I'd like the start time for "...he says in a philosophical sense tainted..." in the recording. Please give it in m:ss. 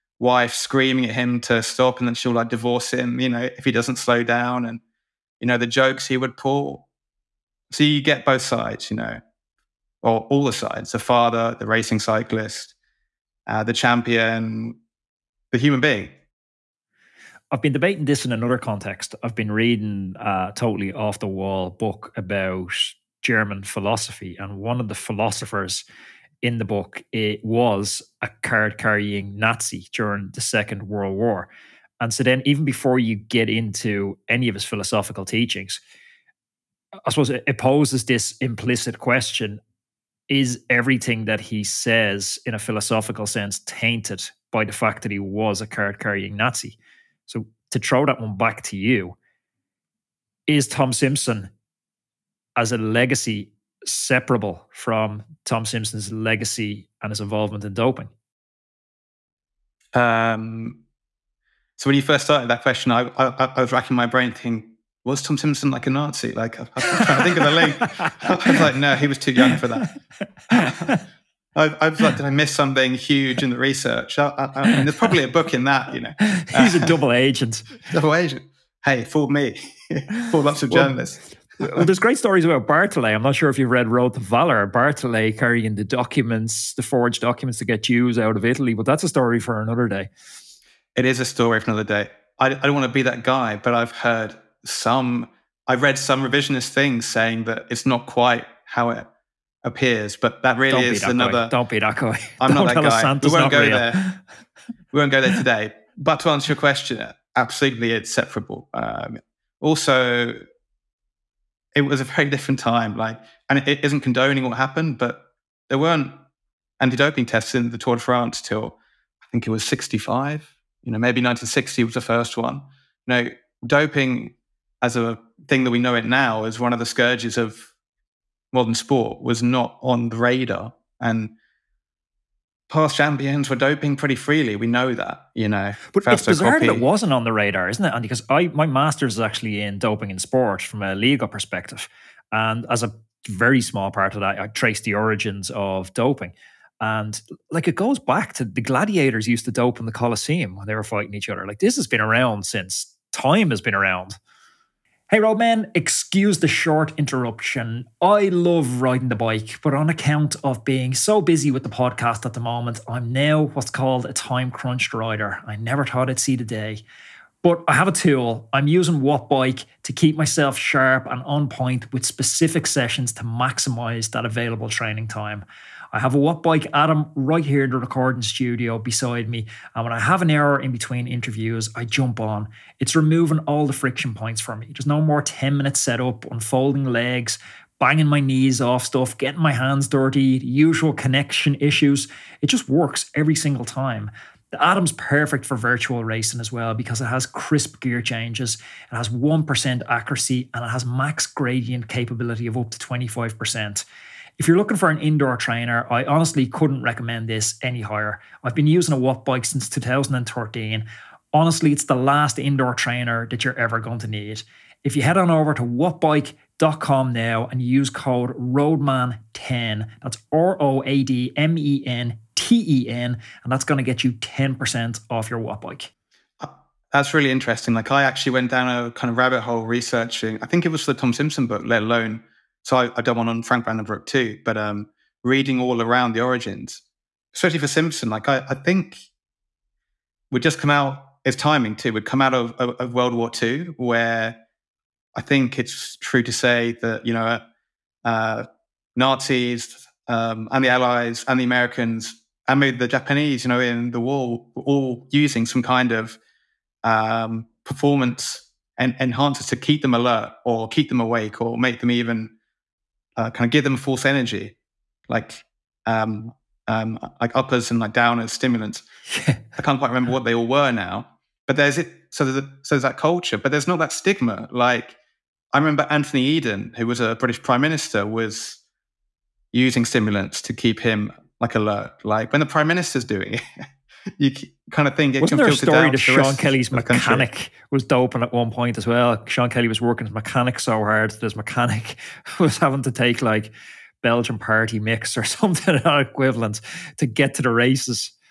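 0:41.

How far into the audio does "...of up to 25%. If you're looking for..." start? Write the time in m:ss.
3:22.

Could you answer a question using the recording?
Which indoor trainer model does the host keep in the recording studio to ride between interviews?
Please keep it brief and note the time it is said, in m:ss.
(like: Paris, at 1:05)
Wattbike Atom, at 2:56.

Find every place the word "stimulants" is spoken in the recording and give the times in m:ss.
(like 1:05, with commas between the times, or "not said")
4:28, 4:39.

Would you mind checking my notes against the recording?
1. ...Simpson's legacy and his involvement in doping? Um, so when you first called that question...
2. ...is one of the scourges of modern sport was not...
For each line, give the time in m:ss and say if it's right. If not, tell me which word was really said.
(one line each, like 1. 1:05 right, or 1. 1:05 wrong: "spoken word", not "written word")
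1. 0:55 wrong: "started", not "called"
2. 2:06 right.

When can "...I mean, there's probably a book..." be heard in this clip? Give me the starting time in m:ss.
1:14.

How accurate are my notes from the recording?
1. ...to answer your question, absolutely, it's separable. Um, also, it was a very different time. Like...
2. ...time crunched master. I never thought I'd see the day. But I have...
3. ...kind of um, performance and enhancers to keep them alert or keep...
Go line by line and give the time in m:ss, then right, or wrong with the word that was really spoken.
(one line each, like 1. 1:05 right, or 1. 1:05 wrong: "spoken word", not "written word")
1. 1:46 right
2. 2:44 wrong: "rider", not "master"
3. 4:15 right.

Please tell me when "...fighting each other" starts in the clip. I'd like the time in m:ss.
2:30.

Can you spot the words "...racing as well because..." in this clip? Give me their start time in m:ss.
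3:16.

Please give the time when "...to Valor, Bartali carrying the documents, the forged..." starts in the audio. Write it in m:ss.
1:24.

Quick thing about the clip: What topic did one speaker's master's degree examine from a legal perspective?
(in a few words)
Doping in sport.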